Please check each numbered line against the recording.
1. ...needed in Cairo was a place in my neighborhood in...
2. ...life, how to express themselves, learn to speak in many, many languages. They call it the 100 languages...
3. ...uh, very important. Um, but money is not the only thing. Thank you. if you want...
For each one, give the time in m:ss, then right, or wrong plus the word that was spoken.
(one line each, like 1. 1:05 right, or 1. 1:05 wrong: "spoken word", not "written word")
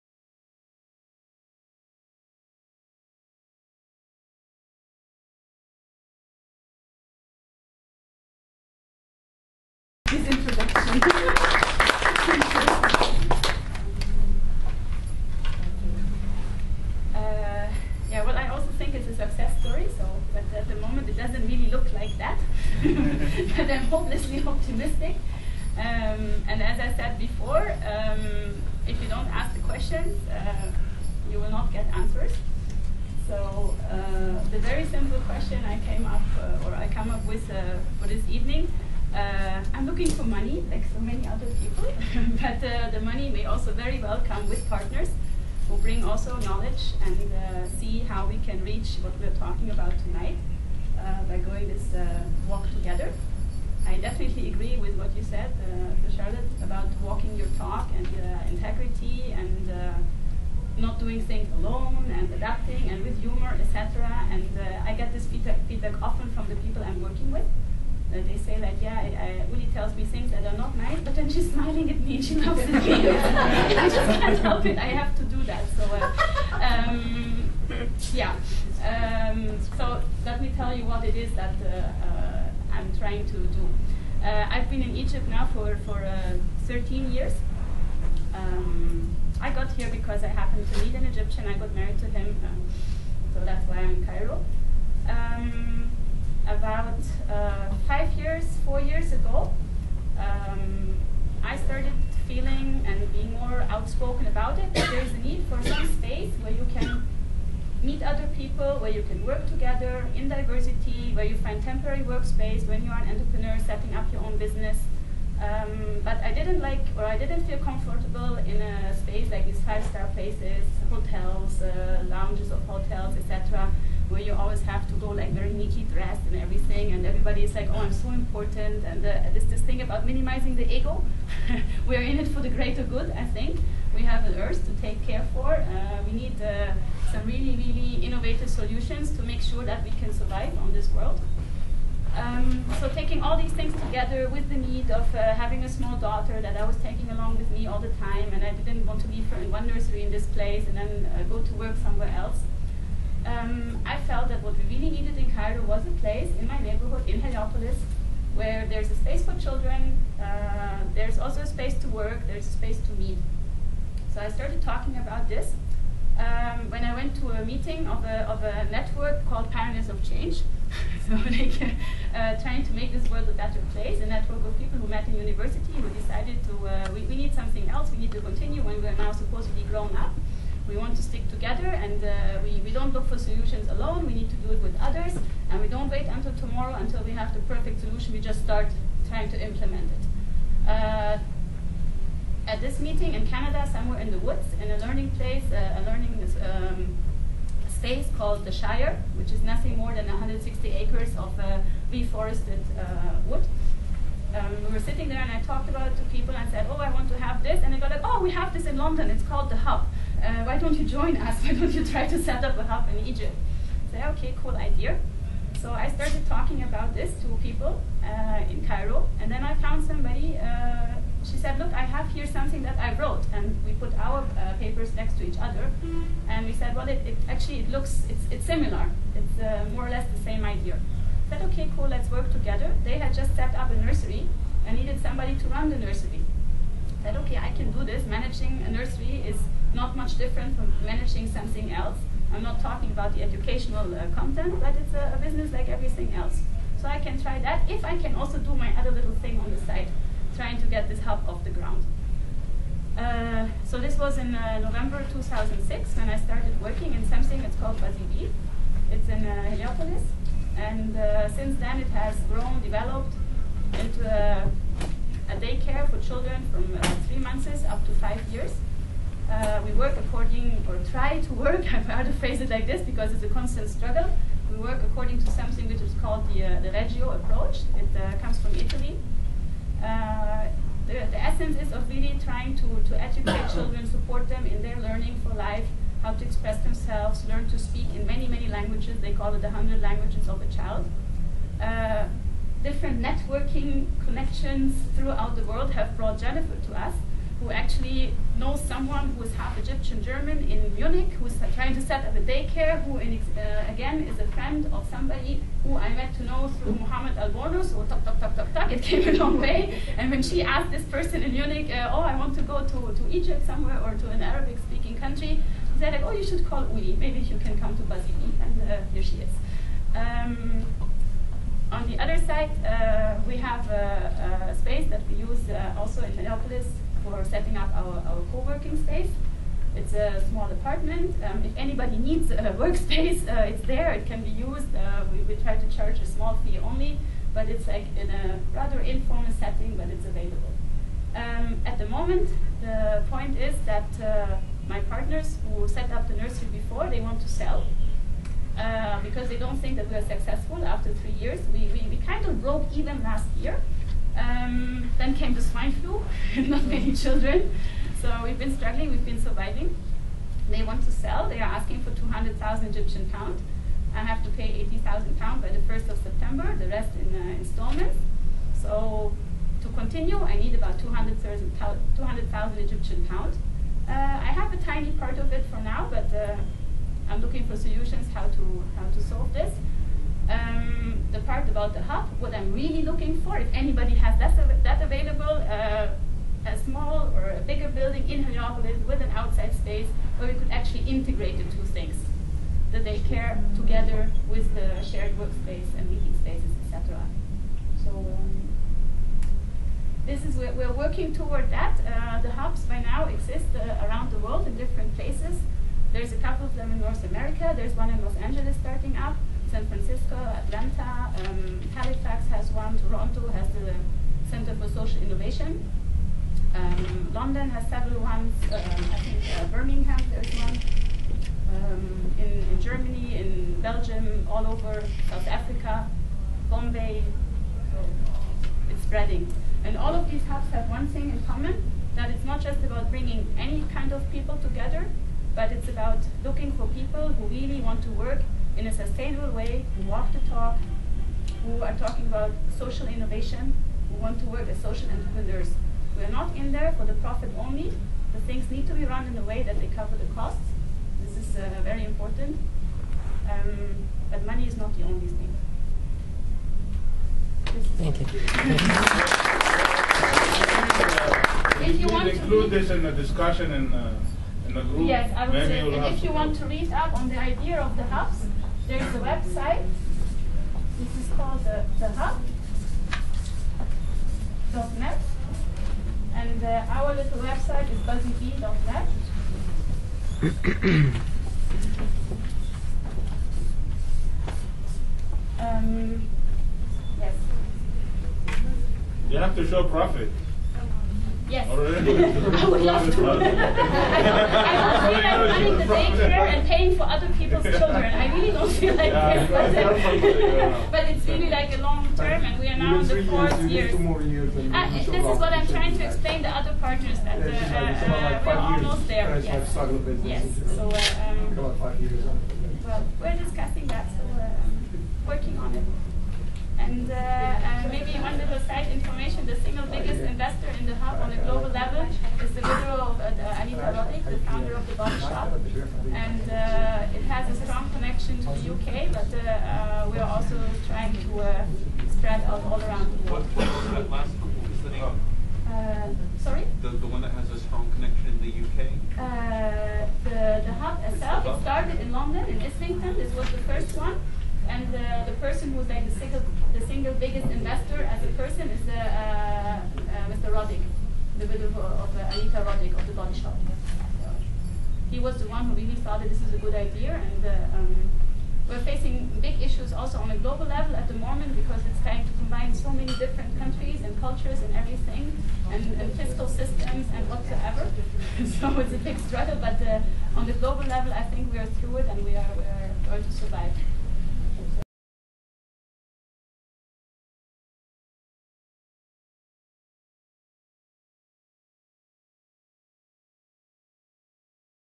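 1. 2:34 right
2. 4:45 right
3. 7:31 right.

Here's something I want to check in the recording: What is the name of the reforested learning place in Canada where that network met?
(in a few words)
the Shire.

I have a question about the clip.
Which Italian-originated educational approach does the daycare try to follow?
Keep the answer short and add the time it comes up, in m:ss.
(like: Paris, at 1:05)
Reggio approach, at 4:36.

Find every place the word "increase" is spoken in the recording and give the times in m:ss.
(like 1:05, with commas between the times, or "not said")
not said.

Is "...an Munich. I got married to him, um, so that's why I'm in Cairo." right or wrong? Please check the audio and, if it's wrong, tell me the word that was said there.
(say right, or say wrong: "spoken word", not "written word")
wrong: "Egyptian", not "Munich".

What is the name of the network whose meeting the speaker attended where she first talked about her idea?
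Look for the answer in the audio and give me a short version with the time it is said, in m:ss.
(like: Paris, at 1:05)
Pioneers of Change, at 2:49.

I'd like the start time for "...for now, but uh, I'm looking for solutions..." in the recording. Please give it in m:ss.
6:15.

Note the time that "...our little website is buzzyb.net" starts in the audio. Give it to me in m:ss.
7:56.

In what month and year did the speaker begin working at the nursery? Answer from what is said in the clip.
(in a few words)
November 2006.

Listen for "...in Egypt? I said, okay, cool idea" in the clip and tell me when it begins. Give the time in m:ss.
3:32.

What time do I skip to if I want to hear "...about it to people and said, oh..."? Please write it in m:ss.
3:25.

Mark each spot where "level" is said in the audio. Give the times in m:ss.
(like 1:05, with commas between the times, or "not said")
9:20, 9:30.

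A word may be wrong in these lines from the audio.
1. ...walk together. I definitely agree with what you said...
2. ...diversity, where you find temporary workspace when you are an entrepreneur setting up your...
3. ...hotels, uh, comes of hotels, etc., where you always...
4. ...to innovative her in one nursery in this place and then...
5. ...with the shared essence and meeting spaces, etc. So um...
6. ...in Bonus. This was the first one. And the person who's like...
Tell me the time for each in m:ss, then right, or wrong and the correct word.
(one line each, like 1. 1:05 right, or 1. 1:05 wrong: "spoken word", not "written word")
1. 0:52 right
2. 1:50 right
3. 2:00 wrong: "lounges", not "comes"
4. 2:29 wrong: "leave", not "innovative"
5. 6:34 wrong: "workspace", not "essence"
6. 9:02 wrong: "Islington", not "Bonus".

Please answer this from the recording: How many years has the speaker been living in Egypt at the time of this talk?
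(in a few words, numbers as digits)
13.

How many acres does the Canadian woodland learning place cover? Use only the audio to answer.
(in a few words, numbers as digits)
160.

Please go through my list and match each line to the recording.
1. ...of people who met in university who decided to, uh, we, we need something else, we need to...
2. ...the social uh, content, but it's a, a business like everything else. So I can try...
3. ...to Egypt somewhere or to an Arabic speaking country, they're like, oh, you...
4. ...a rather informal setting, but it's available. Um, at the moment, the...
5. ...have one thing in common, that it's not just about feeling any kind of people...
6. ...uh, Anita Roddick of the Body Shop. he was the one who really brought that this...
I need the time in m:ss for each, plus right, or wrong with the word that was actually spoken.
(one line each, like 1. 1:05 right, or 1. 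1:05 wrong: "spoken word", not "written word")
1. 2:54 right
2. 4:03 wrong: "educational", not "social"
3. 5:12 right
4. 5:38 right
5. 7:10 wrong: "bringing", not "feeling"
6. 9:11 wrong: "thought", not "brought".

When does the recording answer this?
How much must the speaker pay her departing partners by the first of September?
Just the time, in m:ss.
6:04.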